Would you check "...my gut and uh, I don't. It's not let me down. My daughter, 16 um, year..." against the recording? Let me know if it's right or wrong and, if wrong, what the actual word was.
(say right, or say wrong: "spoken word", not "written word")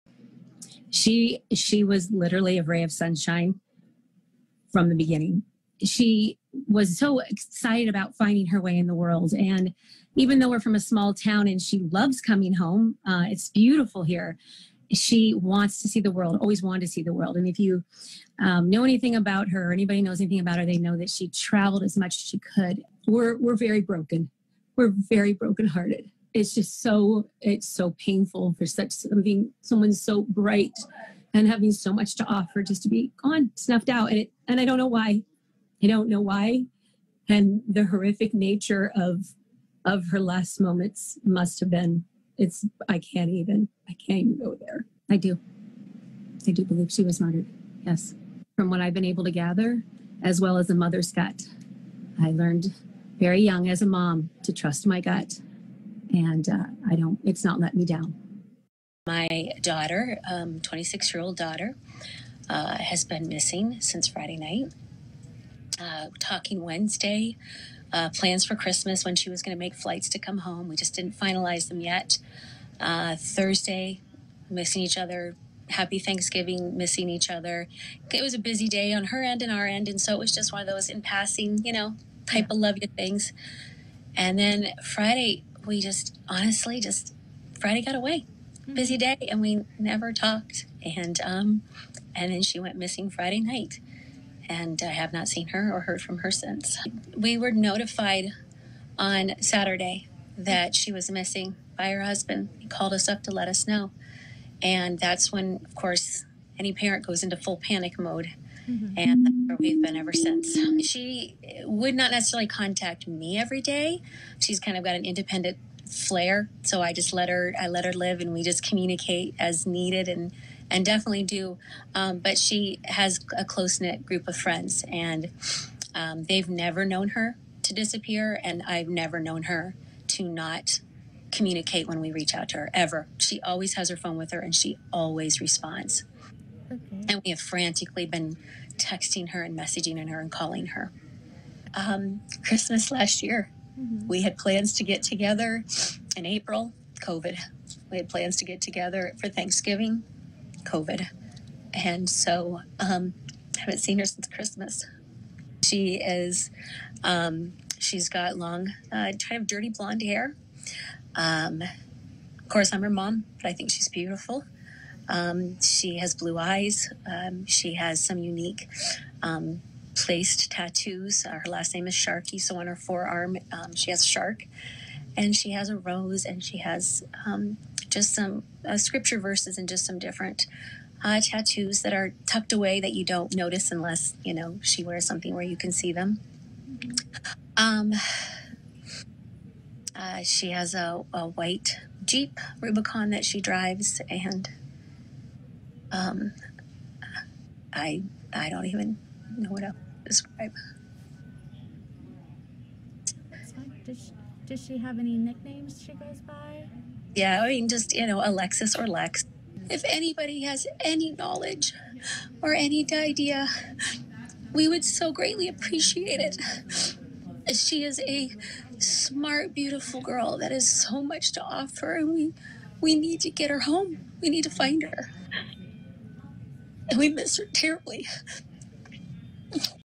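wrong: "26", not "16".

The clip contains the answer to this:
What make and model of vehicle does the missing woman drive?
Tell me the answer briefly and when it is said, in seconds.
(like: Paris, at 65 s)
Jeep Rubicon, at 192 s.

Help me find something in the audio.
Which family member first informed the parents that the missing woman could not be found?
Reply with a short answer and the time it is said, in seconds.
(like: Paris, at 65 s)
Her husband, at 101 s.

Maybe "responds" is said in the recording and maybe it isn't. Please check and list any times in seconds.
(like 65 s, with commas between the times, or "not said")
135 s.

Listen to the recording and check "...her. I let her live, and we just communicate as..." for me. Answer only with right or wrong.
right.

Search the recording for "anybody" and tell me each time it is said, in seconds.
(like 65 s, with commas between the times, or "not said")
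19 s, 209 s.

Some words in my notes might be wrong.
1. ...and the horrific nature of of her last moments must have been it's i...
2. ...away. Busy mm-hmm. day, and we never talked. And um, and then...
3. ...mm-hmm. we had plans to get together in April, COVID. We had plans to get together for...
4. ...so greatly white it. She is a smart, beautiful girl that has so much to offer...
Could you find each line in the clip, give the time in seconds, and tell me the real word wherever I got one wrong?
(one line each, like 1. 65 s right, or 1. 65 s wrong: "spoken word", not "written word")
1. 37 s right
2. 87 s right
3. 143 s right
4. 214 s wrong: "appreciate", not "white".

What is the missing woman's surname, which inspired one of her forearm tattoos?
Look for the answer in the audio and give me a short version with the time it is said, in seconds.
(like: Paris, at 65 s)
Sharkey, at 171 s.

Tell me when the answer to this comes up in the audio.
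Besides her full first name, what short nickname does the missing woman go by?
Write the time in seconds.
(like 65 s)
208 s.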